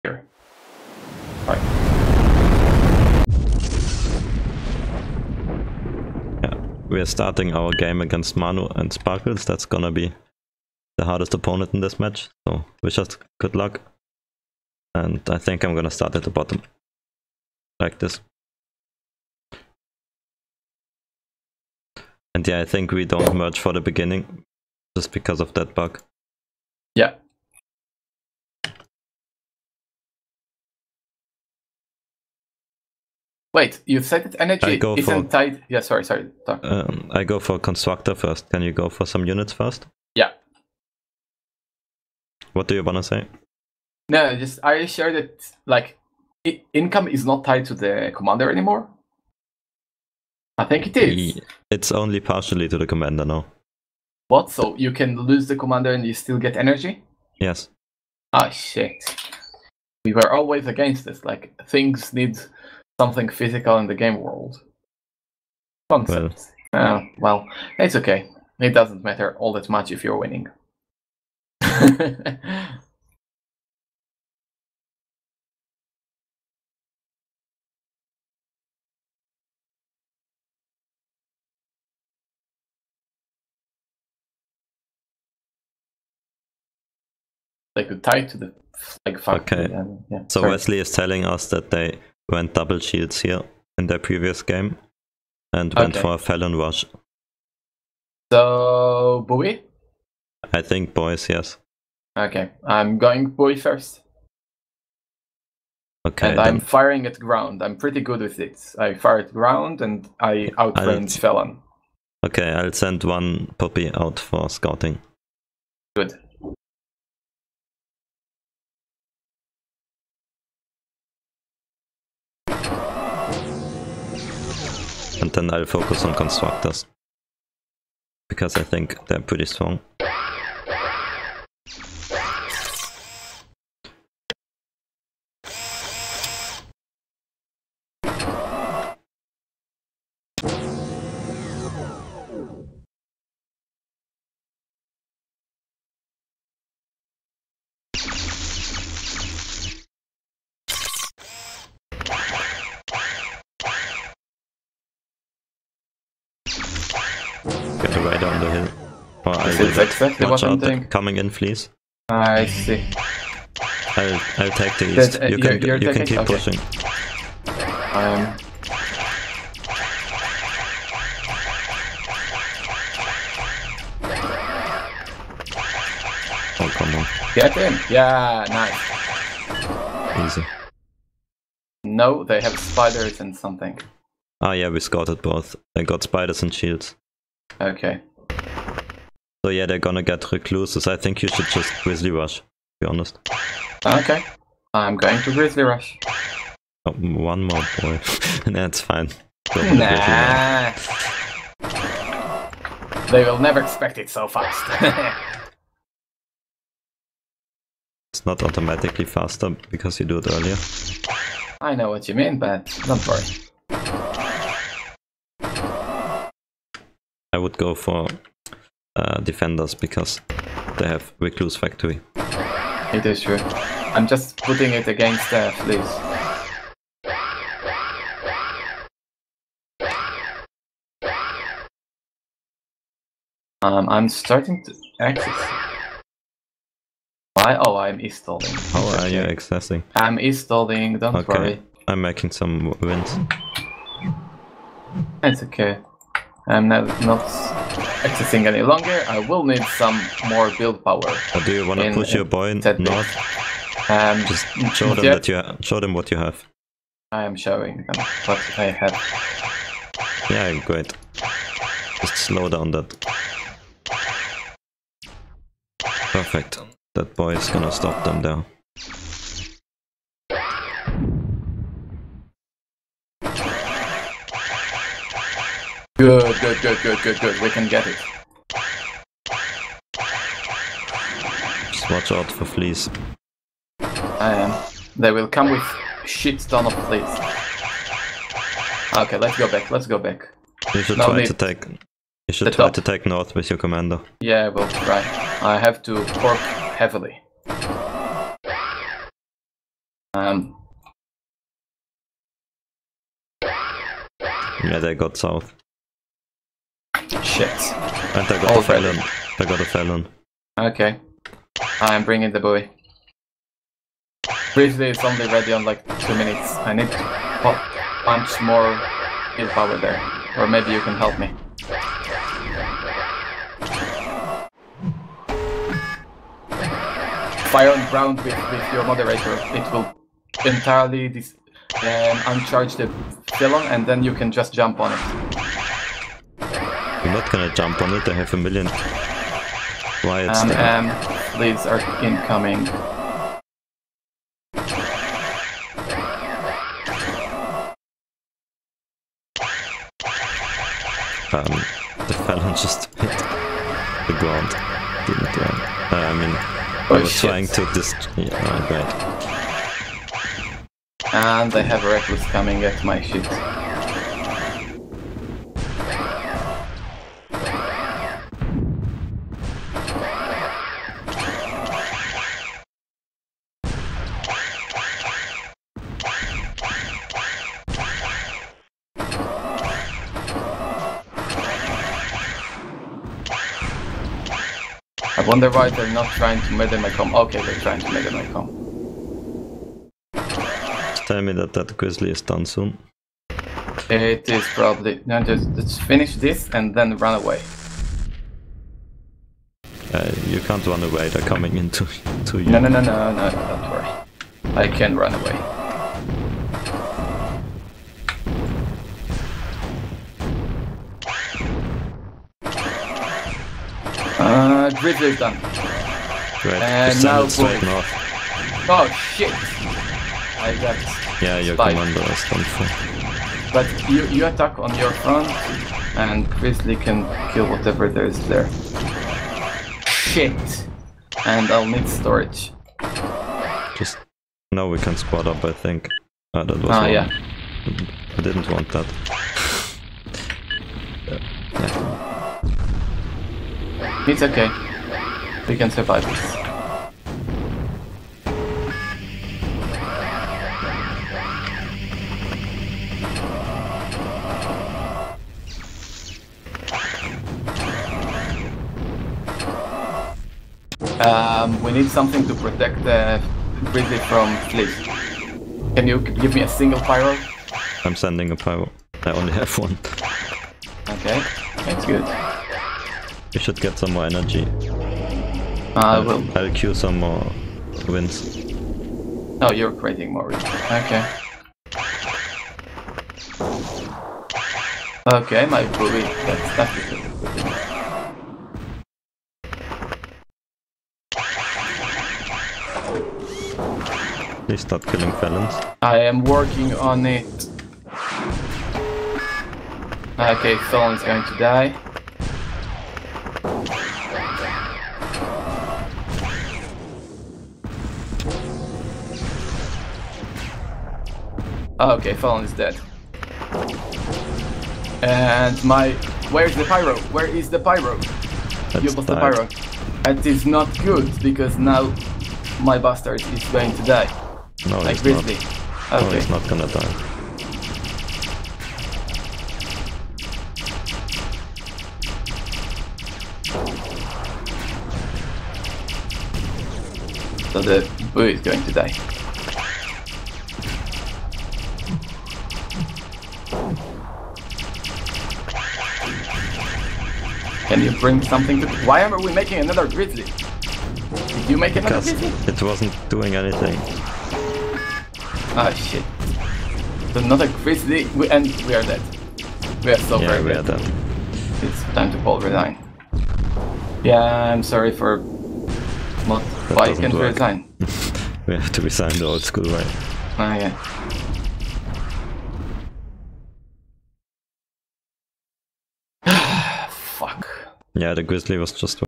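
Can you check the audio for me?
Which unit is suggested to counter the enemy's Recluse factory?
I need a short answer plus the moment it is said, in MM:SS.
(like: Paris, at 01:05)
Defenders, at 03:39.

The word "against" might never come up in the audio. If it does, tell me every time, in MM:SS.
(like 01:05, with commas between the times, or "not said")
00:08, 01:00, 03:44.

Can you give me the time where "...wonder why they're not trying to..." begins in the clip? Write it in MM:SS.
06:25.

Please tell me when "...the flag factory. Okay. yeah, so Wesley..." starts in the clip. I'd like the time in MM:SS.
01:28.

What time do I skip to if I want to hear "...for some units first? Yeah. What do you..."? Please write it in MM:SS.
00:38.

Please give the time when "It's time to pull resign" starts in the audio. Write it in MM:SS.
09:21.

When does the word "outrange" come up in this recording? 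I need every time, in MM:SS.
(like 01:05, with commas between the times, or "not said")
01:50.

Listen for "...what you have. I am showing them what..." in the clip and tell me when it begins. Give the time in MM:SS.
04:15.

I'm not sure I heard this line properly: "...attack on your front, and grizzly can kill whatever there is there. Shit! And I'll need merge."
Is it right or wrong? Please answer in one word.
wrong.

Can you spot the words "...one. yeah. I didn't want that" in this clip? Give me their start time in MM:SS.
07:16.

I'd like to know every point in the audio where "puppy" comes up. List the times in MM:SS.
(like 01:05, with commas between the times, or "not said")
01:53.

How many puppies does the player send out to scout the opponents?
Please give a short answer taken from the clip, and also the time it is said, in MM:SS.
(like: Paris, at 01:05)
1, at 01:53.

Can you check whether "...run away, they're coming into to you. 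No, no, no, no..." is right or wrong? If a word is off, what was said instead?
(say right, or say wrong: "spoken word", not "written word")
right.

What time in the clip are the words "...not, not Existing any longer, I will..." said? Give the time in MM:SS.
04:06.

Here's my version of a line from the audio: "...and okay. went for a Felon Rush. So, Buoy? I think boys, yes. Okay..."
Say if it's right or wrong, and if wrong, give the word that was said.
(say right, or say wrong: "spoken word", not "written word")
right.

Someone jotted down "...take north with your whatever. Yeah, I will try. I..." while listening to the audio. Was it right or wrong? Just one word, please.
wrong.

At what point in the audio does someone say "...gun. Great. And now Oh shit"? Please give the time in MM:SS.
06:55.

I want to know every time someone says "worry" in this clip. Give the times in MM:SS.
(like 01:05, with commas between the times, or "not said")
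03:33, 04:01, 06:43.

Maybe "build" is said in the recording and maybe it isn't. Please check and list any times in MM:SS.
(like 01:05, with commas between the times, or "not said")
04:10.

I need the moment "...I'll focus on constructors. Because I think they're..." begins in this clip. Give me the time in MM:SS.
02:05.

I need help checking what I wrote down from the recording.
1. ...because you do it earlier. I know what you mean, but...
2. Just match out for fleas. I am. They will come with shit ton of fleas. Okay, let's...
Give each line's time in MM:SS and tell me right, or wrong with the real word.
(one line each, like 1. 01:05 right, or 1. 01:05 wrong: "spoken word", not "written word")
1. 03:29 right
2. 04:41 wrong: "watch", not "match".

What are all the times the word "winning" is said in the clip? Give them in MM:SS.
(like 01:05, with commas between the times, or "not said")
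01:10.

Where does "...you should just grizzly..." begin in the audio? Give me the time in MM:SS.
03:11.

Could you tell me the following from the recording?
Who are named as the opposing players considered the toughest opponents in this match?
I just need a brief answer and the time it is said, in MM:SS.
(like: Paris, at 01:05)
Manu and Sparkles, at 00:08.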